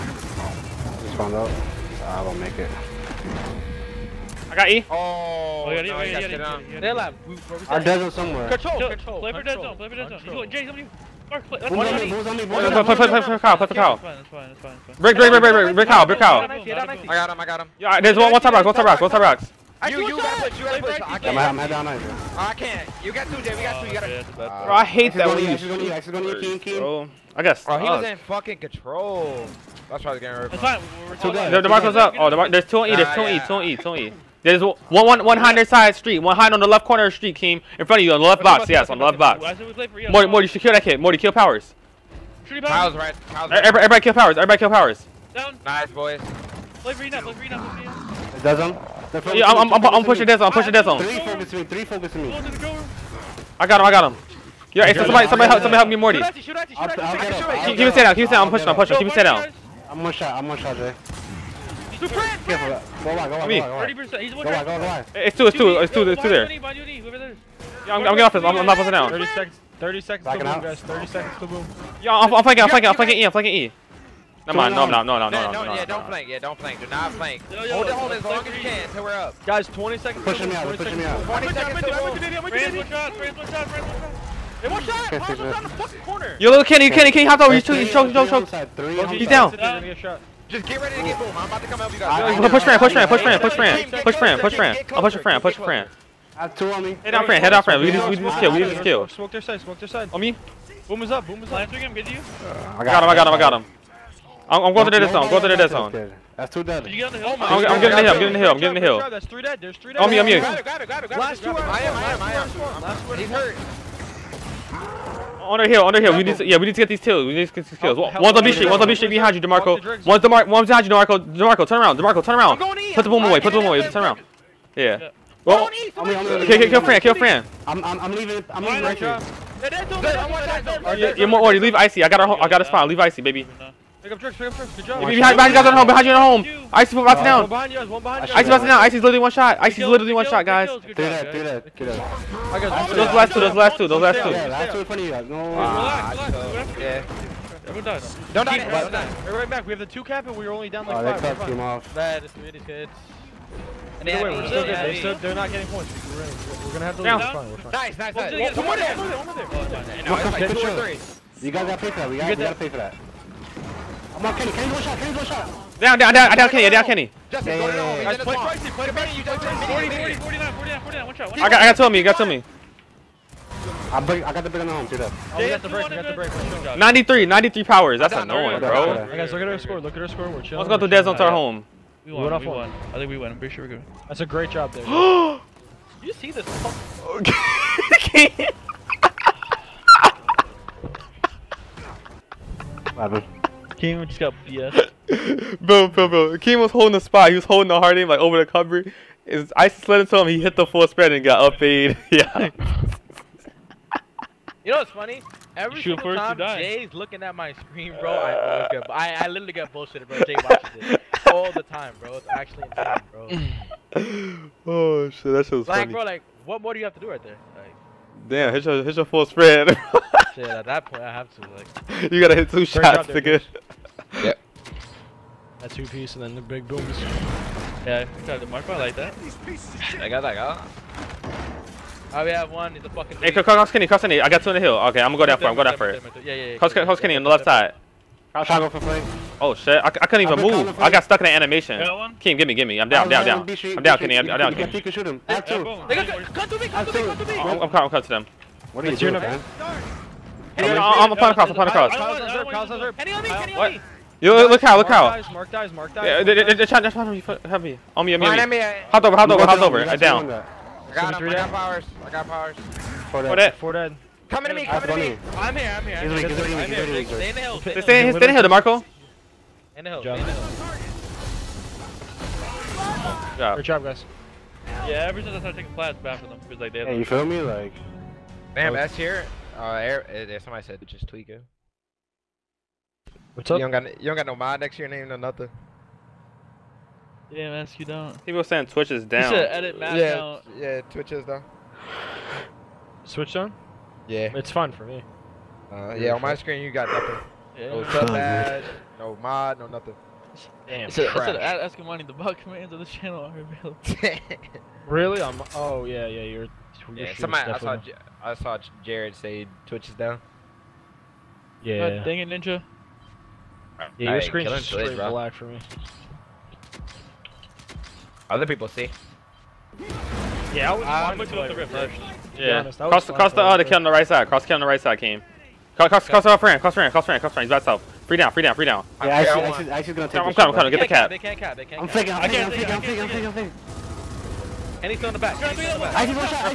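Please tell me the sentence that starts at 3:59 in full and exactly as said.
Oh shit, I, I couldn't even move.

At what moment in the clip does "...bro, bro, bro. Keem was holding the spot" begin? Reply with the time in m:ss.
3:15.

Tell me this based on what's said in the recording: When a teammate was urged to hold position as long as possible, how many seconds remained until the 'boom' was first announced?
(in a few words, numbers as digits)
30.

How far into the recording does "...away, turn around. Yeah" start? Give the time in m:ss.
2:03.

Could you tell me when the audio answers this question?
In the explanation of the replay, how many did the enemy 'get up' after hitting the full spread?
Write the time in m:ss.
3:21.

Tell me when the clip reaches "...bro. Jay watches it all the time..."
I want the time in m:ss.
3:30.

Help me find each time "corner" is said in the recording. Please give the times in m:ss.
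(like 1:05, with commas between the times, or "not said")
0:36, 1:25.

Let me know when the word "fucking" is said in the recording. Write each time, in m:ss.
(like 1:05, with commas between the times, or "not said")
0:28, 1:25, 3:06, 3:52.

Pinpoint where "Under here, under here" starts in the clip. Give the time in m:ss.
1:55.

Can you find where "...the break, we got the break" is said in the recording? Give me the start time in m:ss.
2:55.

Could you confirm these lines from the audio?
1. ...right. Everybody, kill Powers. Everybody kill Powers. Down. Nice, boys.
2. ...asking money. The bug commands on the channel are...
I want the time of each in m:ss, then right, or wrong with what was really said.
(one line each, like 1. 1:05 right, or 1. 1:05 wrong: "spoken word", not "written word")
1. 0:43 right
2. 5:01 right.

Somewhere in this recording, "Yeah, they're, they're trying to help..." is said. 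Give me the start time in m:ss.
4:16.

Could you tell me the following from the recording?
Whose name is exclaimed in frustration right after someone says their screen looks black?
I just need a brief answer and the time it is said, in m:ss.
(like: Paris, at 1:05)
Ninja, at 5:12.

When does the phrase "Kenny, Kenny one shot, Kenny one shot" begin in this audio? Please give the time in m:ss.
2:44.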